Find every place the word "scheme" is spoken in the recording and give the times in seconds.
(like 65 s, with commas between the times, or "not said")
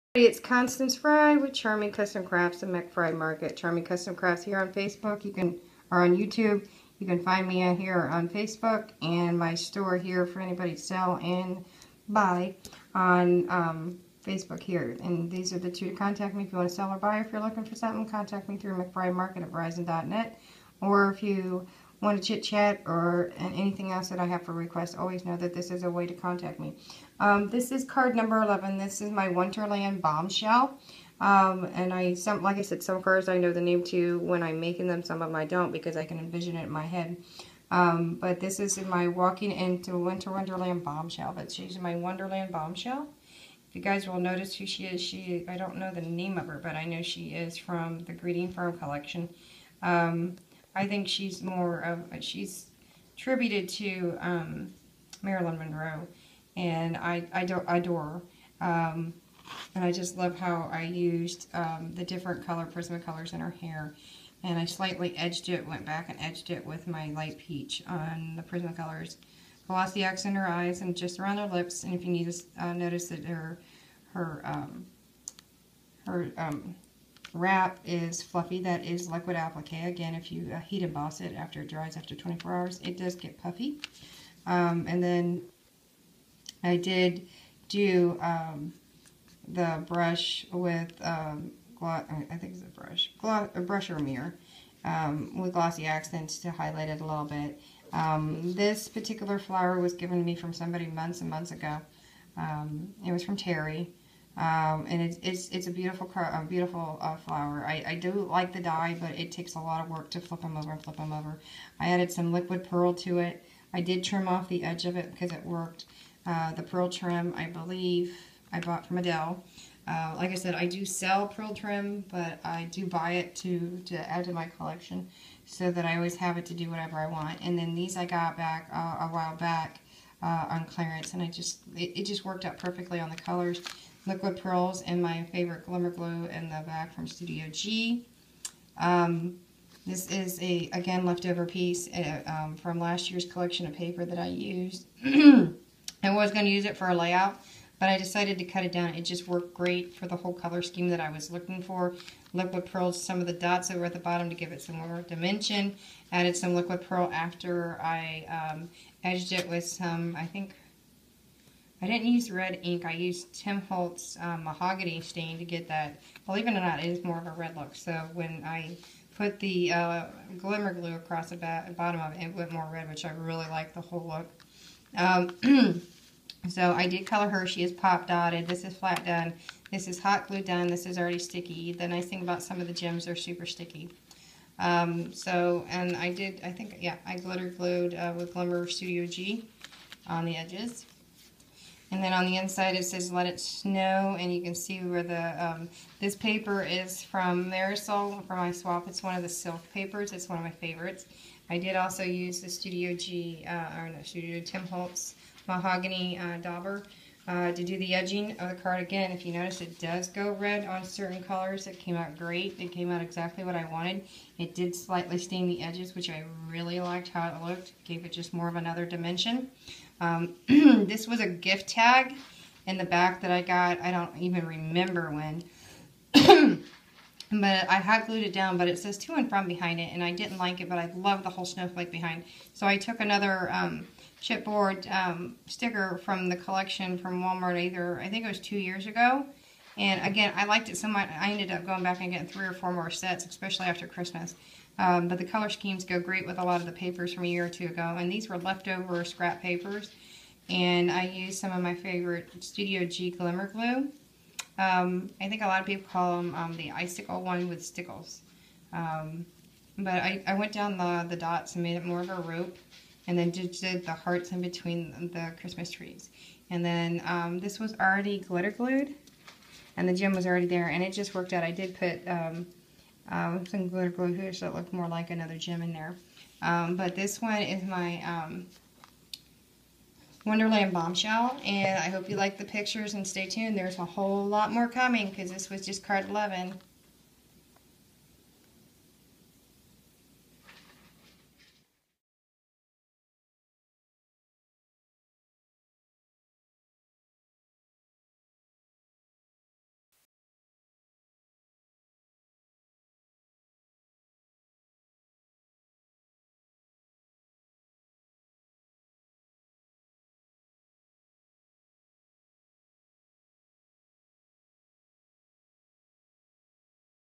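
150 s, 245 s.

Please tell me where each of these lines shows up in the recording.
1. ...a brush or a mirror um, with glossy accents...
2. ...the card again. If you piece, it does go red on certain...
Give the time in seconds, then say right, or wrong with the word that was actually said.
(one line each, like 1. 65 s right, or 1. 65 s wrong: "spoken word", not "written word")
1. 93 s right
2. 208 s wrong: "notice", not "piece".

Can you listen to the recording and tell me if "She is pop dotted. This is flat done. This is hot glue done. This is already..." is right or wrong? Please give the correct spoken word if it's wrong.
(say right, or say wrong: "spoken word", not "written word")
right.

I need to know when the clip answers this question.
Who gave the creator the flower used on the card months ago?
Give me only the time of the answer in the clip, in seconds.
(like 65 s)
103 s.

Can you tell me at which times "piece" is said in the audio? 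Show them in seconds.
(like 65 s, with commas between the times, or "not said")
141 s.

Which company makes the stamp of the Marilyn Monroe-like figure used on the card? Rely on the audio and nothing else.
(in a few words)
Greeting Farm.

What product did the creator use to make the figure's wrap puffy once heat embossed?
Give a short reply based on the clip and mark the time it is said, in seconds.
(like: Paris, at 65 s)
liquid applique, at 79 s.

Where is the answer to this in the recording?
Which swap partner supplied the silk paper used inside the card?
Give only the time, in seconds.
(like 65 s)
197 s.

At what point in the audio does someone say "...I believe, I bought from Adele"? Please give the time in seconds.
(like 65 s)
117 s.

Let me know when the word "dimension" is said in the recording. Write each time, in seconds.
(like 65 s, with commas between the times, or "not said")
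155 s, 218 s.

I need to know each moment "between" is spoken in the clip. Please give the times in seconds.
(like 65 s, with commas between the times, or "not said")
264 s.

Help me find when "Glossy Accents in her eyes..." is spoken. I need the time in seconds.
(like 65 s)
69 s.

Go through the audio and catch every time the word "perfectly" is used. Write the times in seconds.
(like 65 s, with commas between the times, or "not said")
132 s.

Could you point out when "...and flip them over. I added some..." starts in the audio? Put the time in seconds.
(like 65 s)
110 s.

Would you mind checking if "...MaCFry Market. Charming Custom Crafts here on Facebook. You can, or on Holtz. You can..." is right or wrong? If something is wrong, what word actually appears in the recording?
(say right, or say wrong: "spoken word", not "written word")
wrong: "YouTube", not "Holtz".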